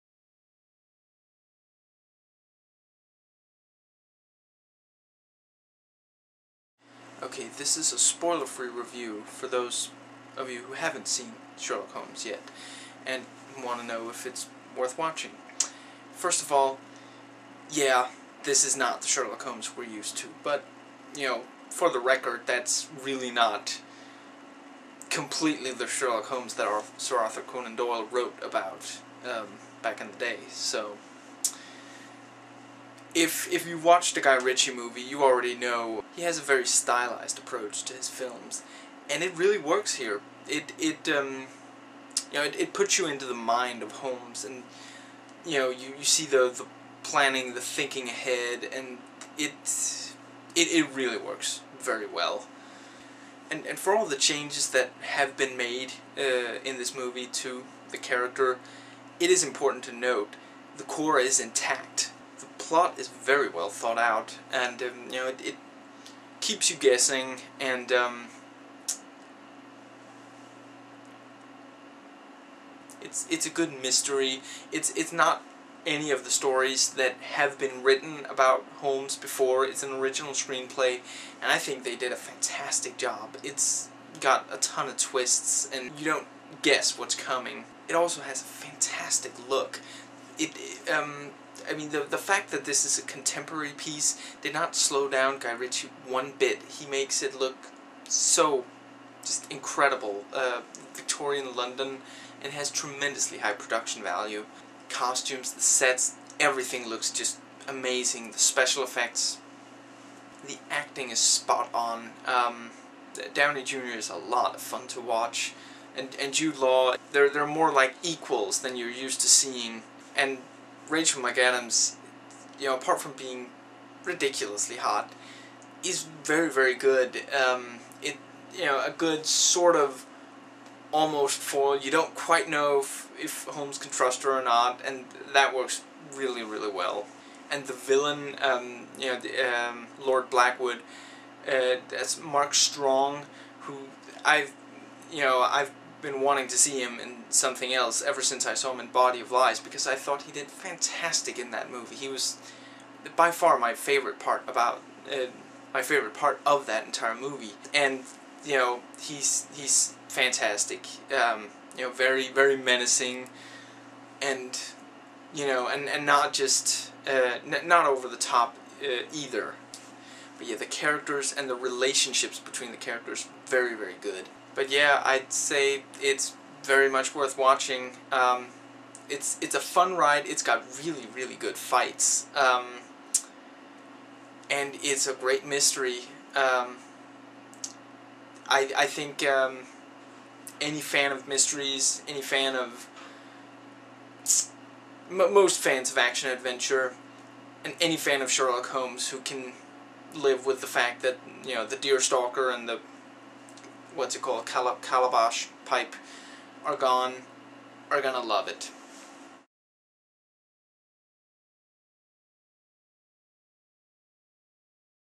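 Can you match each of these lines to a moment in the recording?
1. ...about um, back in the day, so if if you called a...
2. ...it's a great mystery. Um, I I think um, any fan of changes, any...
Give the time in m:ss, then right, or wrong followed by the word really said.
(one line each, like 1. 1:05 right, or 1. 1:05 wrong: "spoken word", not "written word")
1. 0:28 wrong: "watched", not "called"
2. 3:04 wrong: "mysteries", not "changes".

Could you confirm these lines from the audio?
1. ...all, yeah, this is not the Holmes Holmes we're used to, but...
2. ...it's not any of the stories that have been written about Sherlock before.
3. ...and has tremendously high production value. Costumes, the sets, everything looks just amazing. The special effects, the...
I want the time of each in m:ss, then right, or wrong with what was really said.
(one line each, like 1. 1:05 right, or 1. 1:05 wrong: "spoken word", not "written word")
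1. 0:16 wrong: "Sherlock", not "Holmes"
2. 1:14 wrong: "Holmes", not "Sherlock"
3. 1:42 right.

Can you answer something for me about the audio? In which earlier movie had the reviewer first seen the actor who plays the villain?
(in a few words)
Body of Lies.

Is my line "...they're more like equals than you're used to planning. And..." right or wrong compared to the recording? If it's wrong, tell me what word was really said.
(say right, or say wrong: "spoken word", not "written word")
wrong: "seeing", not "planning".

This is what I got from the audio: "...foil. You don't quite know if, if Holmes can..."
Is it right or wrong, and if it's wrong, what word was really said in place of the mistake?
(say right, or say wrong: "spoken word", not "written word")
right.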